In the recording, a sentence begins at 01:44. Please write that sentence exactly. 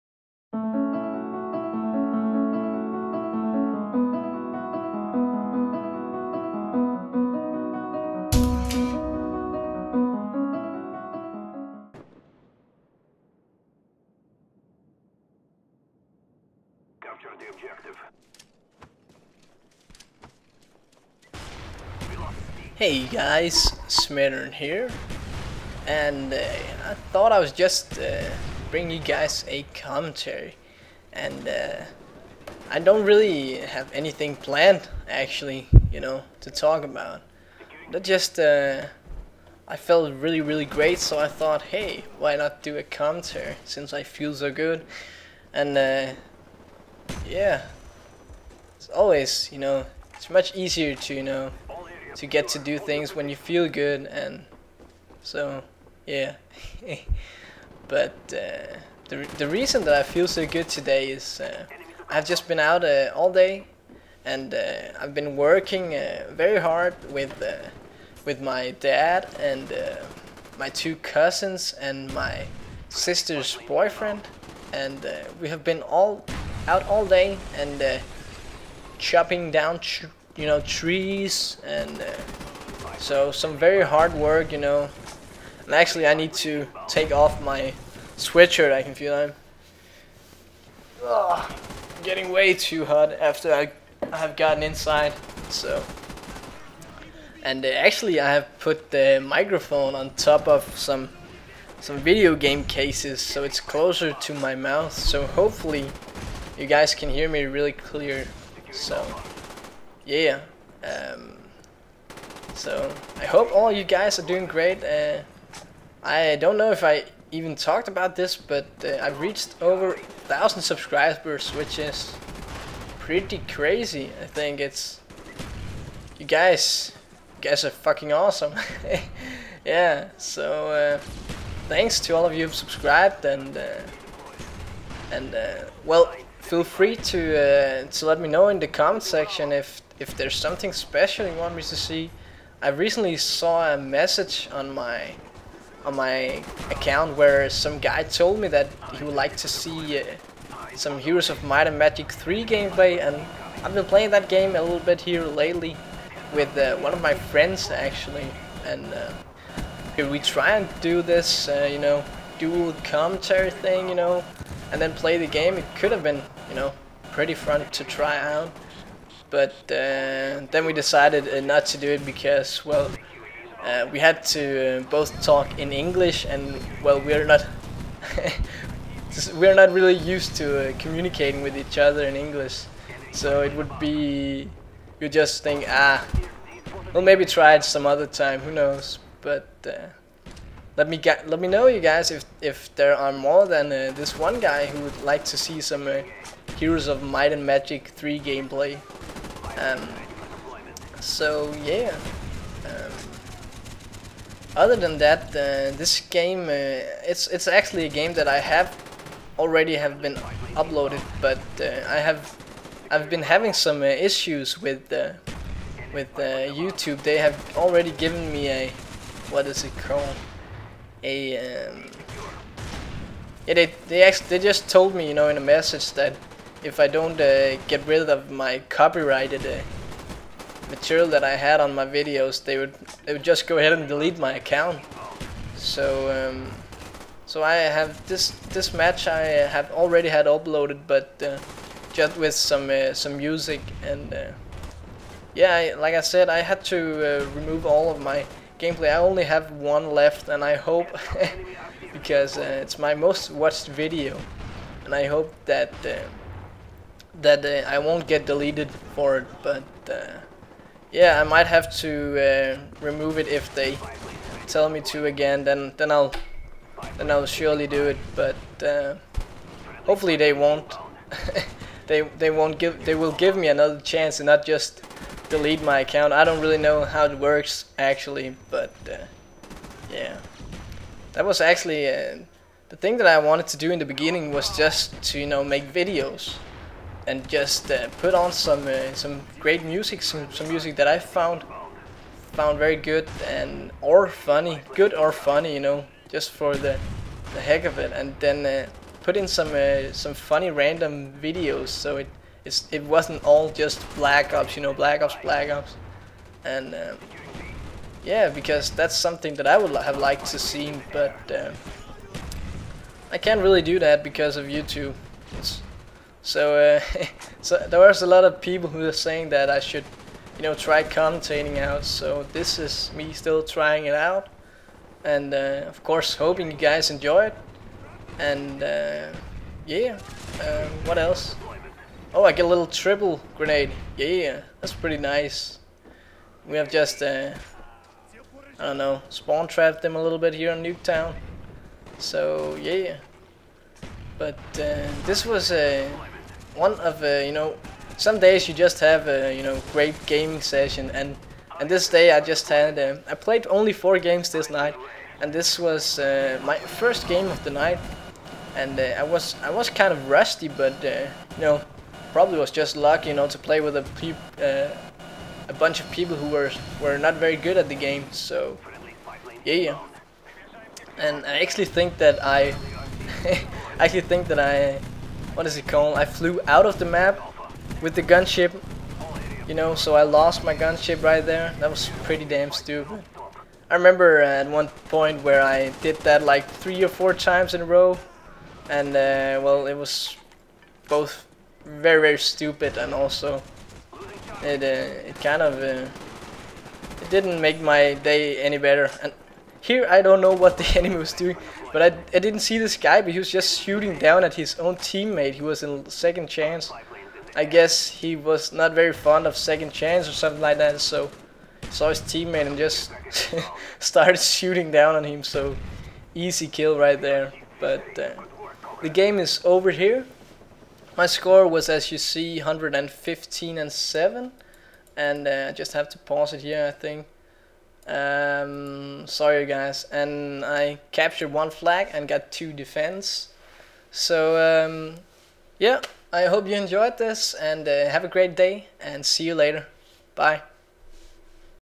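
So hopefully, you guys can hear me really clear.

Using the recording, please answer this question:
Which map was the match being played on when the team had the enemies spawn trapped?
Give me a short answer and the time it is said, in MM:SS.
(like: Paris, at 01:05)
Nuketown, at 05:40.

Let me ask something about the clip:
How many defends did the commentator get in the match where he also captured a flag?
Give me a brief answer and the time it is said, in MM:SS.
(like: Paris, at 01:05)
2, at 07:12.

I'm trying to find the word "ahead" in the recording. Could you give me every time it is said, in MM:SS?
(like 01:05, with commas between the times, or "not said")
03:53.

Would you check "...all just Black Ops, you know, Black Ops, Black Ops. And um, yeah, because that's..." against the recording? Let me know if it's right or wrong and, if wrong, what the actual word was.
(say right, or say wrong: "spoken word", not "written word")
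right.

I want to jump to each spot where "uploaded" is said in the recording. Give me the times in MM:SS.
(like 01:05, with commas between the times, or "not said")
03:30, 04:00.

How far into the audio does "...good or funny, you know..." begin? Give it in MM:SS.
04:54.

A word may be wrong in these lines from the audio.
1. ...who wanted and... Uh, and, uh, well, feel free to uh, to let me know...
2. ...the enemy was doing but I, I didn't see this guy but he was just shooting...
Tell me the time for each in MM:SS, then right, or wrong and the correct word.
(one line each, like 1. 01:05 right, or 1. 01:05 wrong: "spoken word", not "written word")
1. 02:12 wrong: "subscribed", not "wanted"
2. 06:40 right.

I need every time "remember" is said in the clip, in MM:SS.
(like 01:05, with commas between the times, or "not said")
06:23.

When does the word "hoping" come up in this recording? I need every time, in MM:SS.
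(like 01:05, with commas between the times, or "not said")
05:26.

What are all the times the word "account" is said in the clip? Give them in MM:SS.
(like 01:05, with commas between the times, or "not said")
02:26, 03:54, 04:35.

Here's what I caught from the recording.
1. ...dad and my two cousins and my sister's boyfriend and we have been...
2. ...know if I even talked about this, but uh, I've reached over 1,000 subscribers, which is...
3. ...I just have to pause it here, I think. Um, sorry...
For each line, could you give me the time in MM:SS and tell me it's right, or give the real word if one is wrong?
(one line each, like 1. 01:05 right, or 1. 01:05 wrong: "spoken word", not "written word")
1. 01:08 right
2. 01:56 right
3. 07:05 right.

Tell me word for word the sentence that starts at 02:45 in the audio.
It could have been, you know, pretty fun to try out.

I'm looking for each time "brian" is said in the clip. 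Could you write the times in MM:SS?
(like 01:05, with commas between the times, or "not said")
not said.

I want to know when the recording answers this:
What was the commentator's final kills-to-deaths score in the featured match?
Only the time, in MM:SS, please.
07:02.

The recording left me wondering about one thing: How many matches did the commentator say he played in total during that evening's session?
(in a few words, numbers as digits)
4.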